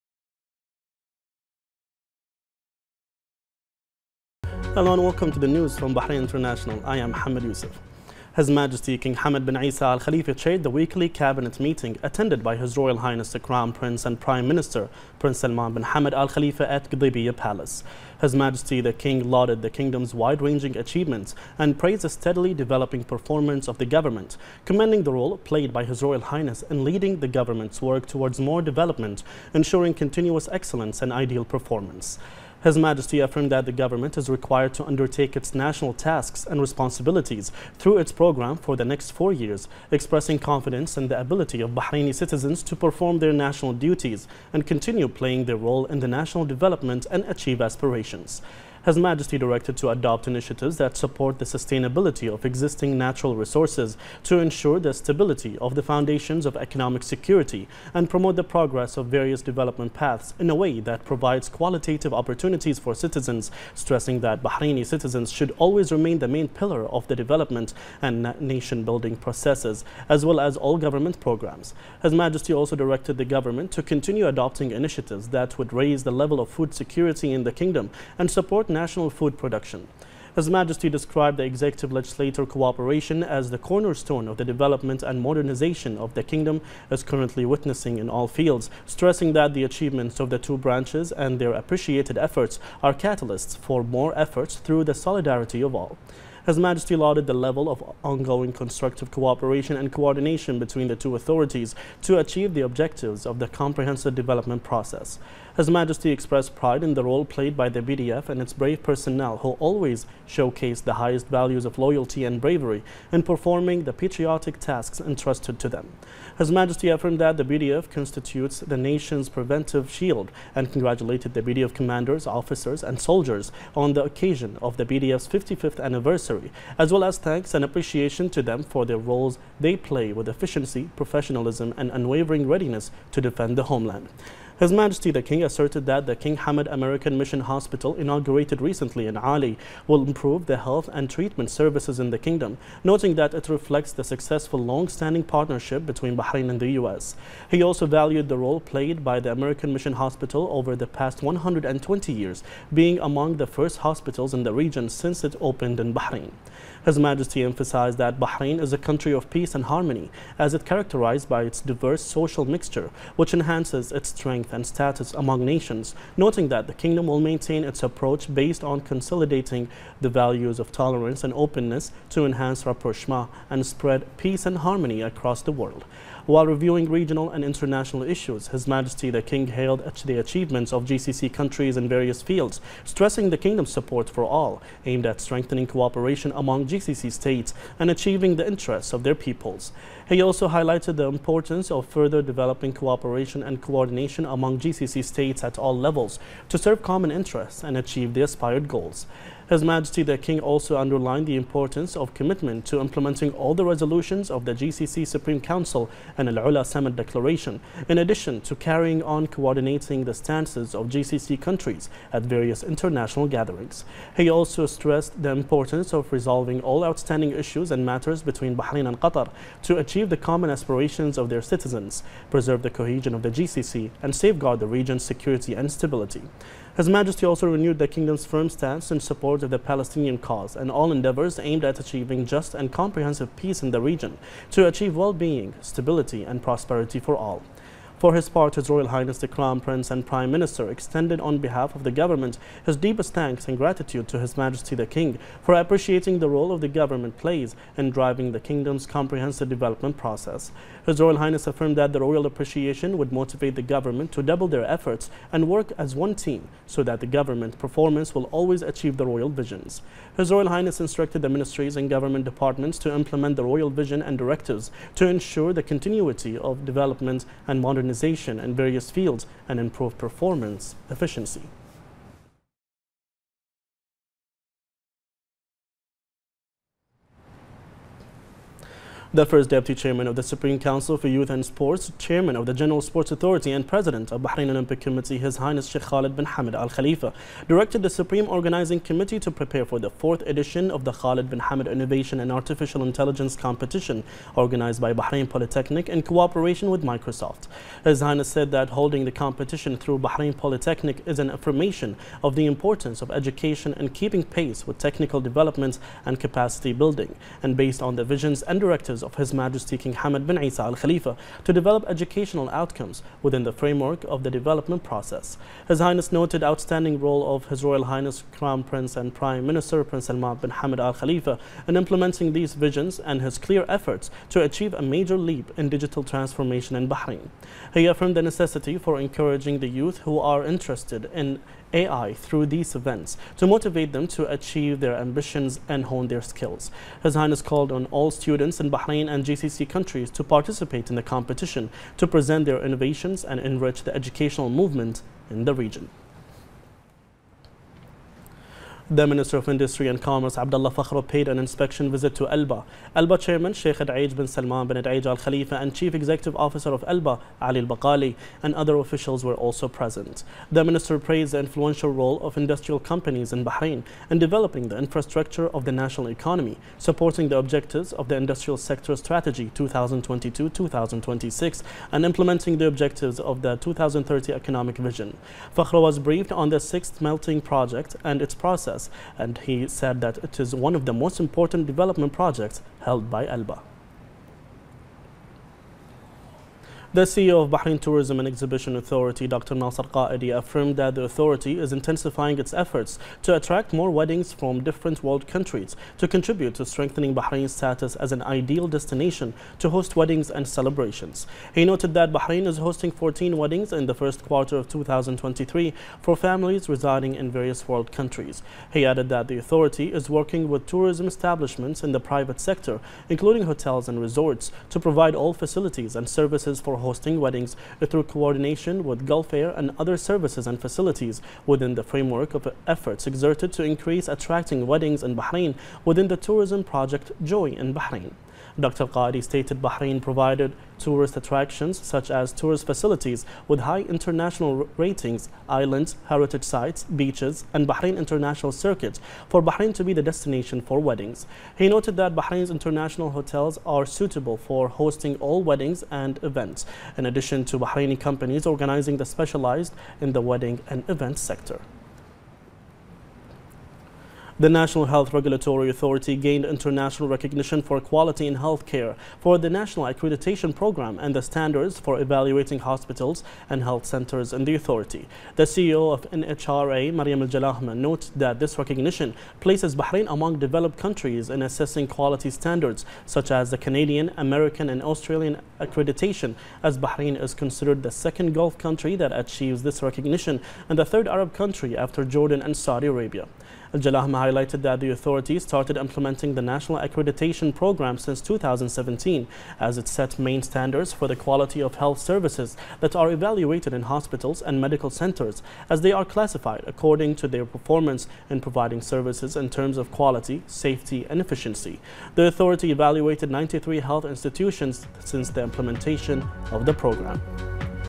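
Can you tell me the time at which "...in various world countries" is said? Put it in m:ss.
6:47.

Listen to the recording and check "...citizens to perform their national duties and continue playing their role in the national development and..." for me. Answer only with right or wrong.
right.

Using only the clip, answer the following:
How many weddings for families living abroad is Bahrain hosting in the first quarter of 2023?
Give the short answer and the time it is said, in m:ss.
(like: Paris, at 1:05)
14, at 6:42.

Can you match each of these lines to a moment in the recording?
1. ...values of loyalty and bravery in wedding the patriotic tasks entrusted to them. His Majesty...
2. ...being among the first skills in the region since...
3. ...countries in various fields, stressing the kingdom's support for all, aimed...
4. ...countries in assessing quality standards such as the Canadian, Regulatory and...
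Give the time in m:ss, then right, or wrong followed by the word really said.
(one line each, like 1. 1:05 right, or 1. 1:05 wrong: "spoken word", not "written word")
1. 1:51 wrong: "performing", not "wedding"
2. 2:32 wrong: "hospitals", not "skills"
3. 3:01 right
4. 7:50 wrong: "American", not "Regulatory".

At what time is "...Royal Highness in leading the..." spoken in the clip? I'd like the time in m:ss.
0:26.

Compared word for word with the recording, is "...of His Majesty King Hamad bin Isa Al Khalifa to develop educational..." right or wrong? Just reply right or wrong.
right.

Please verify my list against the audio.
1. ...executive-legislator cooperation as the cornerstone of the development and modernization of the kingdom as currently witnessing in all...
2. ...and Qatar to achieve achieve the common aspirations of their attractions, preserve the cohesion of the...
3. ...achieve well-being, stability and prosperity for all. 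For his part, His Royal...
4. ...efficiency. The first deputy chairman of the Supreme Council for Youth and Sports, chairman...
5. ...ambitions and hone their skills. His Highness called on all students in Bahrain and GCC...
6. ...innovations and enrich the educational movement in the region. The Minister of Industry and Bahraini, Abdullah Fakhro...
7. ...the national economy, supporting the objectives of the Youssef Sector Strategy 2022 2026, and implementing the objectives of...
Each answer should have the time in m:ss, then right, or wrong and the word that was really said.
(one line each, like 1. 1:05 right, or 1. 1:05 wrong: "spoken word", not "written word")
1. 1:21 right
2. 3:38 wrong: "citizens", not "attractions"
3. 3:54 right
4. 4:30 right
5. 5:34 right
6. 5:42 wrong: "Commerce", not "Bahraini"
7. 6:05 wrong: "Industrial", not "Youssef".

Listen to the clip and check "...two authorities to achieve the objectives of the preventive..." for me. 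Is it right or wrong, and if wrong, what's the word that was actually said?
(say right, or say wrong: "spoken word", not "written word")
wrong: "comprehensive", not "preventive".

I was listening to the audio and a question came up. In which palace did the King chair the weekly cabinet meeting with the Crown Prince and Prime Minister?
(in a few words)
Qadibiyah Palace.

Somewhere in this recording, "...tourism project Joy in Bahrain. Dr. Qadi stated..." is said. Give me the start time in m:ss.
7:06.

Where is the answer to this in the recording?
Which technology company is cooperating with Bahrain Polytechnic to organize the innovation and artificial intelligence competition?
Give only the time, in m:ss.
4:56.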